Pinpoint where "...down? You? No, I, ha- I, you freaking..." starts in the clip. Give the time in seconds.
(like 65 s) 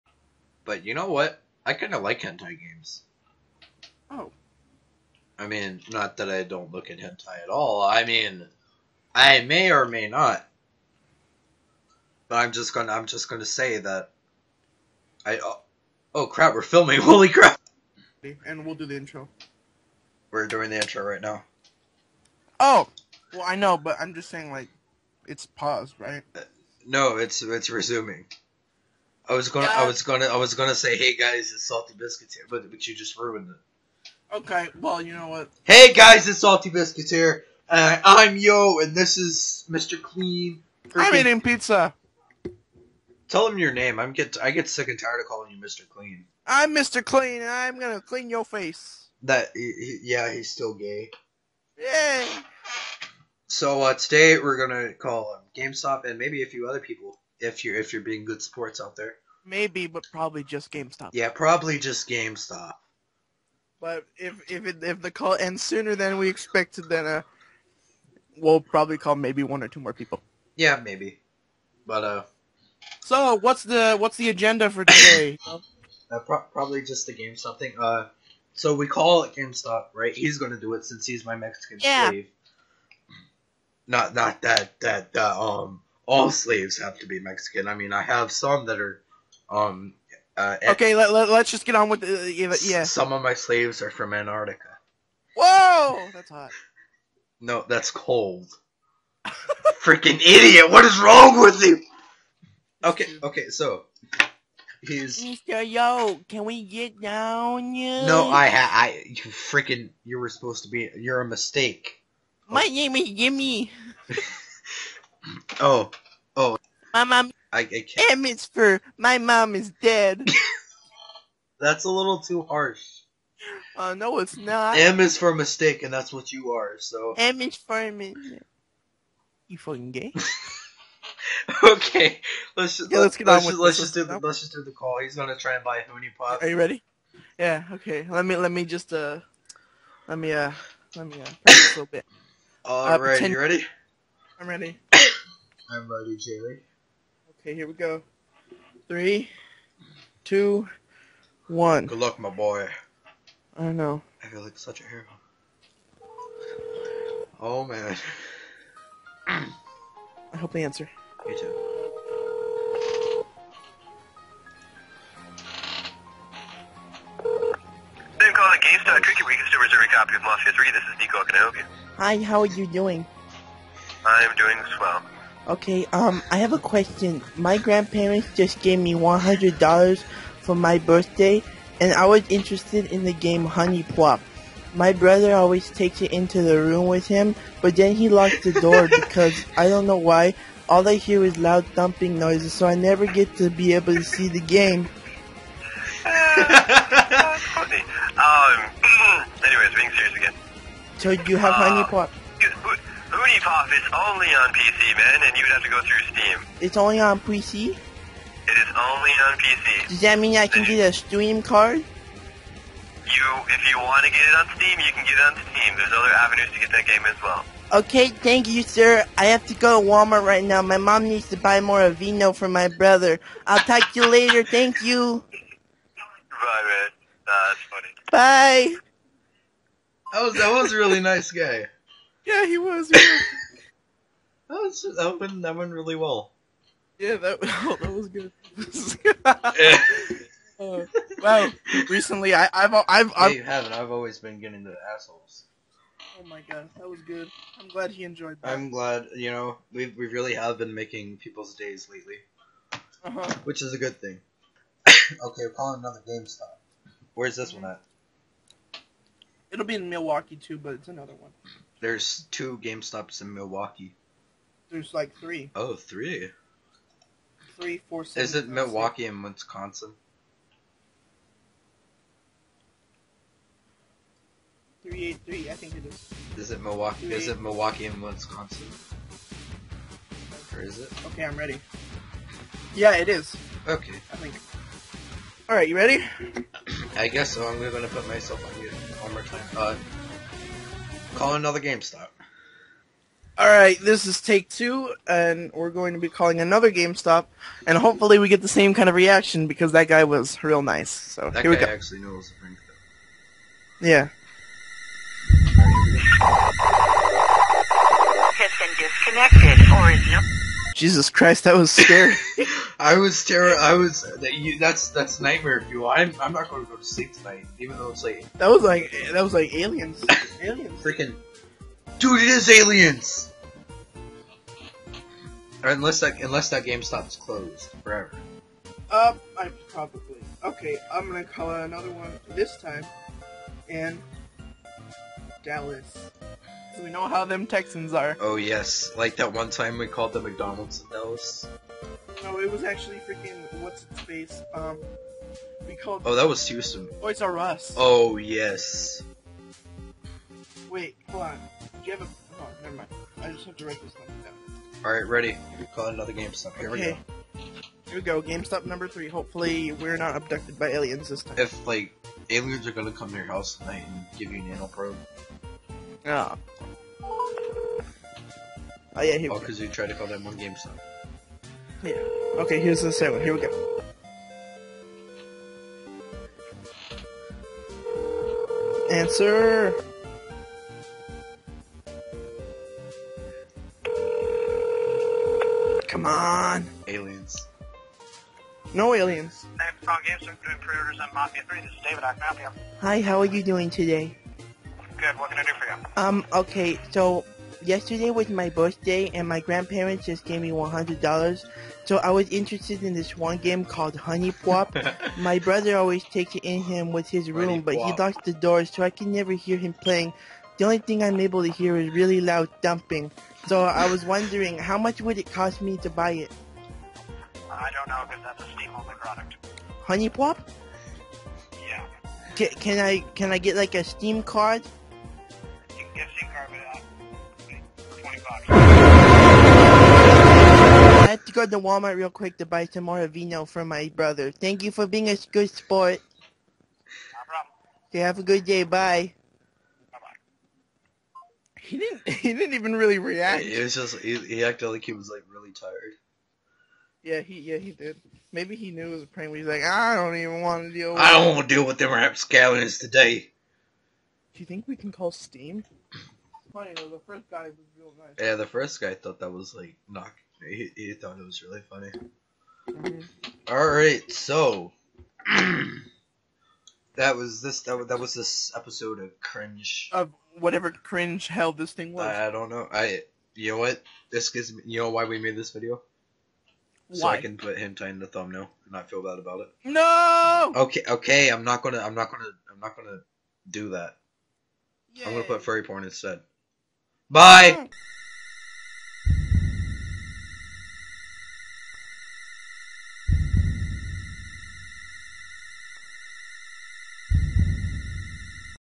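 106 s.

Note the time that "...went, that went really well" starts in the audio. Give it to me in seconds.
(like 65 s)
235 s.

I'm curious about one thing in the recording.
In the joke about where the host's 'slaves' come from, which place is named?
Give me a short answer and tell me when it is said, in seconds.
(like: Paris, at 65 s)
Antarctica, at 94 s.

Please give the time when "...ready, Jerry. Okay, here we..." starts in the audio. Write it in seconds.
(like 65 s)
145 s.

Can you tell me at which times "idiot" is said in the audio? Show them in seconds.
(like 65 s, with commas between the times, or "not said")
100 s.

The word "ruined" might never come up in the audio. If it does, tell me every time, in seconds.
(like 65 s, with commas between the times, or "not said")
33 s.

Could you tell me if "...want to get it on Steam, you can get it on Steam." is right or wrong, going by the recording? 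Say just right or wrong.
right.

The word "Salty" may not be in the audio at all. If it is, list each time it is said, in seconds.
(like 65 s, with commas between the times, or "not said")
31 s, 36 s.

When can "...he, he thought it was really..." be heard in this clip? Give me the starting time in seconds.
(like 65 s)
460 s.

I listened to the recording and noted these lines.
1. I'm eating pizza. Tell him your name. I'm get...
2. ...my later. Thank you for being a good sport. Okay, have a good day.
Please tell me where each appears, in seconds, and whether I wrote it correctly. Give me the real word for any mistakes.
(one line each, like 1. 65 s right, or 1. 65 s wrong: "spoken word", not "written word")
1. 41 s right
2. 433 s wrong: "brother", not "later".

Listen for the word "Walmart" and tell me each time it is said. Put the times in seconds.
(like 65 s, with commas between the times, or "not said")
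219 s, 431 s.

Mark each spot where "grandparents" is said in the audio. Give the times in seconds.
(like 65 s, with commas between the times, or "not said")
177 s, 399 s.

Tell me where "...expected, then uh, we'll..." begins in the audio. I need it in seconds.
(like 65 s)
66 s.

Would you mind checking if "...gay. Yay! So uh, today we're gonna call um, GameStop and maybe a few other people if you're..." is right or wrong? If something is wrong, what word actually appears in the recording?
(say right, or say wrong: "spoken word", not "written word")
right.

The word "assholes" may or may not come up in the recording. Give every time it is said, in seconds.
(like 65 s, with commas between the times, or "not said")
244 s.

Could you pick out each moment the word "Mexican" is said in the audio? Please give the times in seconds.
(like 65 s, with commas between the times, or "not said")
81 s, 87 s.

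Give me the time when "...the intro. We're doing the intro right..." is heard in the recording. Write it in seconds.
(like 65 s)
18 s.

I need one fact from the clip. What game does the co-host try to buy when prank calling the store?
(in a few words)
HuniePop.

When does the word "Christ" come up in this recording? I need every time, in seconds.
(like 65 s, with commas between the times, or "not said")
311 s.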